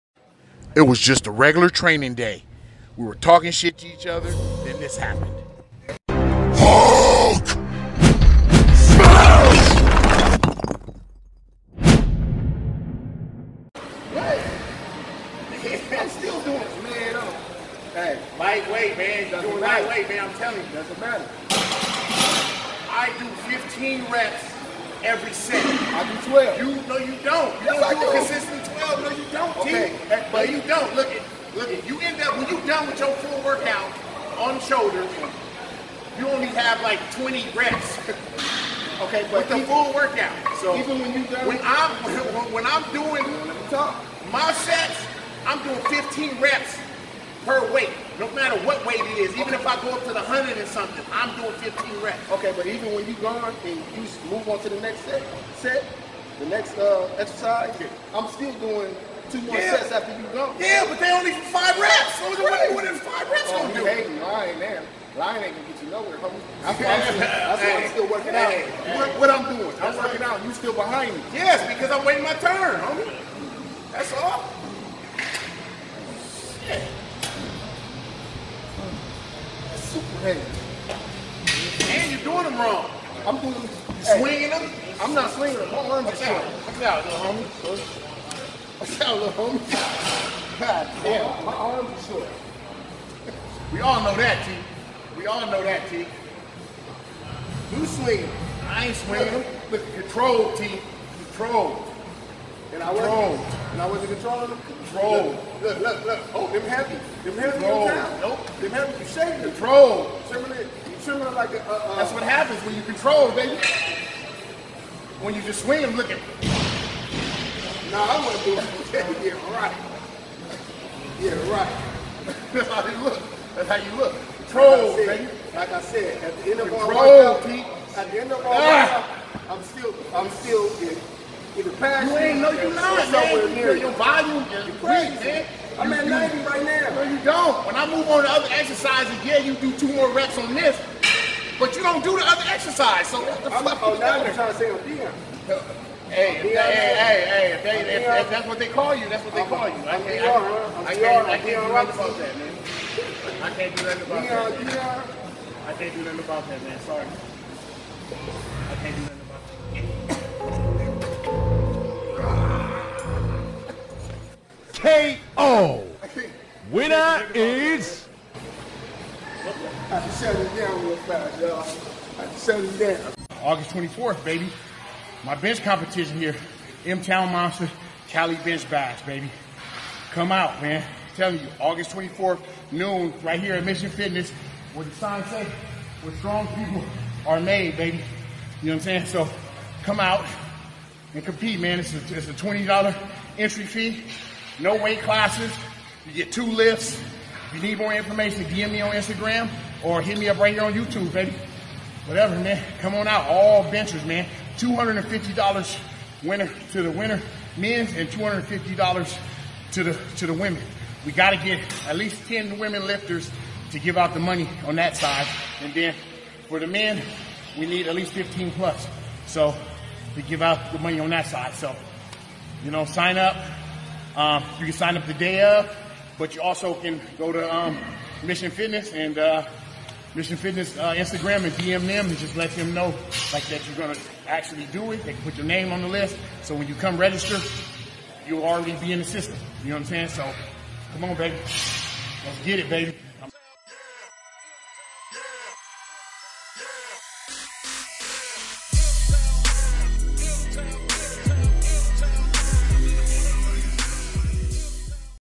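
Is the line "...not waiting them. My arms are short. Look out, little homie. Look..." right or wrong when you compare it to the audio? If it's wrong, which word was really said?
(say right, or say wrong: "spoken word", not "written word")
wrong: "swinging", not "waiting".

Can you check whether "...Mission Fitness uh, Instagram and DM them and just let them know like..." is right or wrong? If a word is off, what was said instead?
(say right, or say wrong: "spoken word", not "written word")
right.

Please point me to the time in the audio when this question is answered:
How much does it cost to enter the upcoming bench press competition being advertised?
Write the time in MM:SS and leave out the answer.
03:12.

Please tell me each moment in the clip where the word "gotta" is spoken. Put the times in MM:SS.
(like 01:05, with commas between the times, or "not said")
03:31.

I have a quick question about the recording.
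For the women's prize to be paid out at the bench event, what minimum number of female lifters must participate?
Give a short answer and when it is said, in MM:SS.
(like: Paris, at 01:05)
10, at 03:32.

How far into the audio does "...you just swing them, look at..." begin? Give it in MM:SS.
01:55.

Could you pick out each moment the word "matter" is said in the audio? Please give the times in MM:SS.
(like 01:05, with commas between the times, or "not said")
00:21, 00:48.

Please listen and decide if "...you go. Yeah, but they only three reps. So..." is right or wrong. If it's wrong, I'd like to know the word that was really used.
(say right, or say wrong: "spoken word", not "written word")
wrong: "five", not "three".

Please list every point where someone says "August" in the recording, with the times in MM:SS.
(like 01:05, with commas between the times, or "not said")
02:53, 03:01.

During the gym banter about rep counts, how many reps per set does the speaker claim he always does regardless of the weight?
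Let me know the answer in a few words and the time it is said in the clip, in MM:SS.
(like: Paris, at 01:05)
15, at 00:23.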